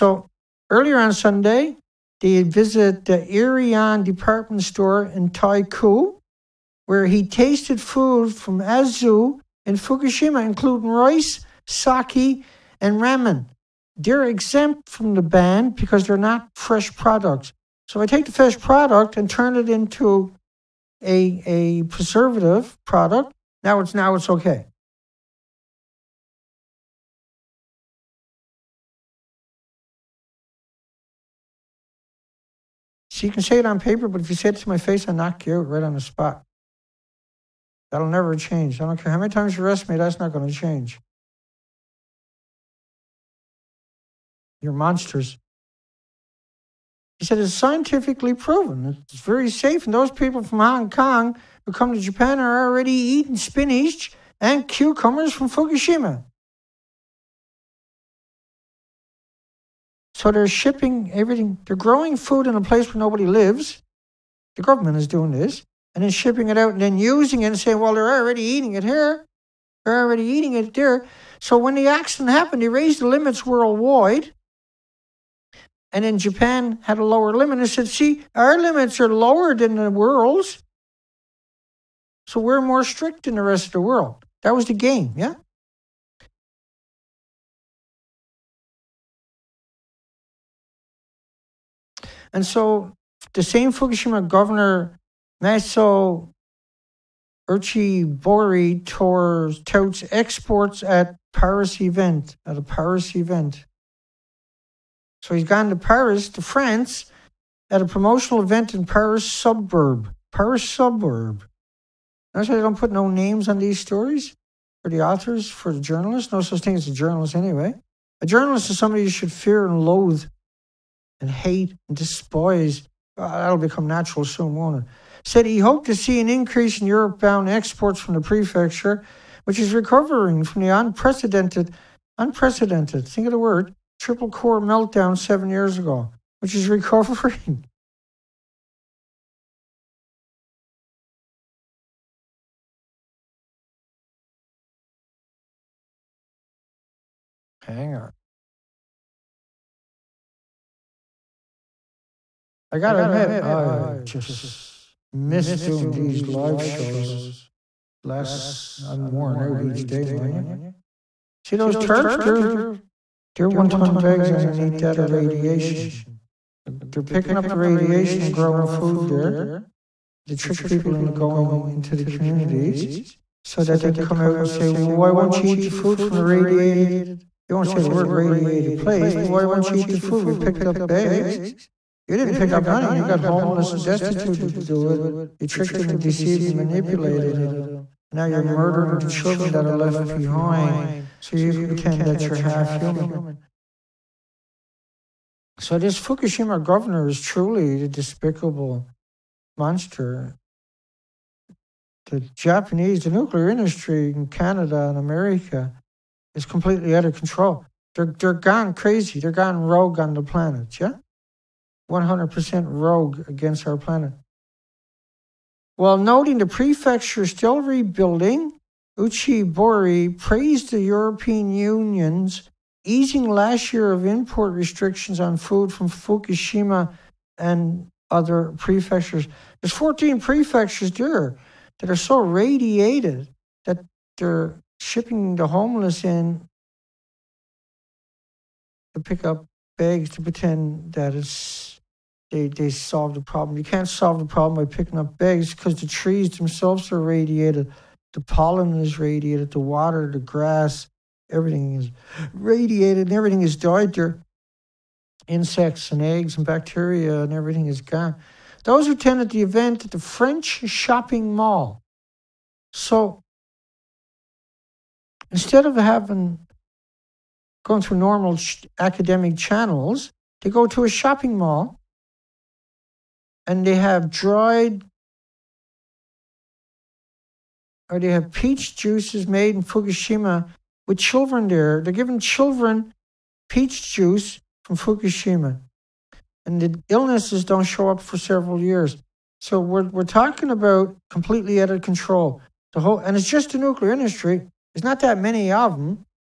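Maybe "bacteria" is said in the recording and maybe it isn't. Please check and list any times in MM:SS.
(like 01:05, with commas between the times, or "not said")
04:16.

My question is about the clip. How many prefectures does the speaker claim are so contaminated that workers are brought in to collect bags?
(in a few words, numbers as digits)
14.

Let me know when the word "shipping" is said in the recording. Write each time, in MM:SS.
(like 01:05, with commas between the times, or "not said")
01:00, 01:06, 03:54.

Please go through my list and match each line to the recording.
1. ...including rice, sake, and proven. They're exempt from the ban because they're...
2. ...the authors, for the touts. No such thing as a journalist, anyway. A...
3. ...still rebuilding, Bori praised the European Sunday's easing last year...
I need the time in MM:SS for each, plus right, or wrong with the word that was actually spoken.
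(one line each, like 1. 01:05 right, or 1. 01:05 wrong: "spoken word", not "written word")
1. 00:10 wrong: "ramen", not "proven"
2. 01:54 wrong: "journalists", not "touts"
3. 03:37 wrong: "Union", not "Sunday".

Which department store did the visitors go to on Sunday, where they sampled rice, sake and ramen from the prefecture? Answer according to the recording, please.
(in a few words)
AEON.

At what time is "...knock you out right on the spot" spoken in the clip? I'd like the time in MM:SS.
00:35.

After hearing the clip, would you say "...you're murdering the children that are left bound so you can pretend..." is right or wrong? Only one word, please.
wrong.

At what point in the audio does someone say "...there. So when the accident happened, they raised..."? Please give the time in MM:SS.
01:10.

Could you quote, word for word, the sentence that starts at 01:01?
They're growing food in a place where nobody lives.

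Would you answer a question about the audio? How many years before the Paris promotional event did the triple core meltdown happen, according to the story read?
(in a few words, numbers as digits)
7.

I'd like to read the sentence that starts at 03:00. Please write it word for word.
We picked up bags you didn't pick up nothing.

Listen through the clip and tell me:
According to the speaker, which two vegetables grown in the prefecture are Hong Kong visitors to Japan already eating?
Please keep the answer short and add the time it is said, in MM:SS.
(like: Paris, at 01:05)
Spinach and cucumbers, at 00:53.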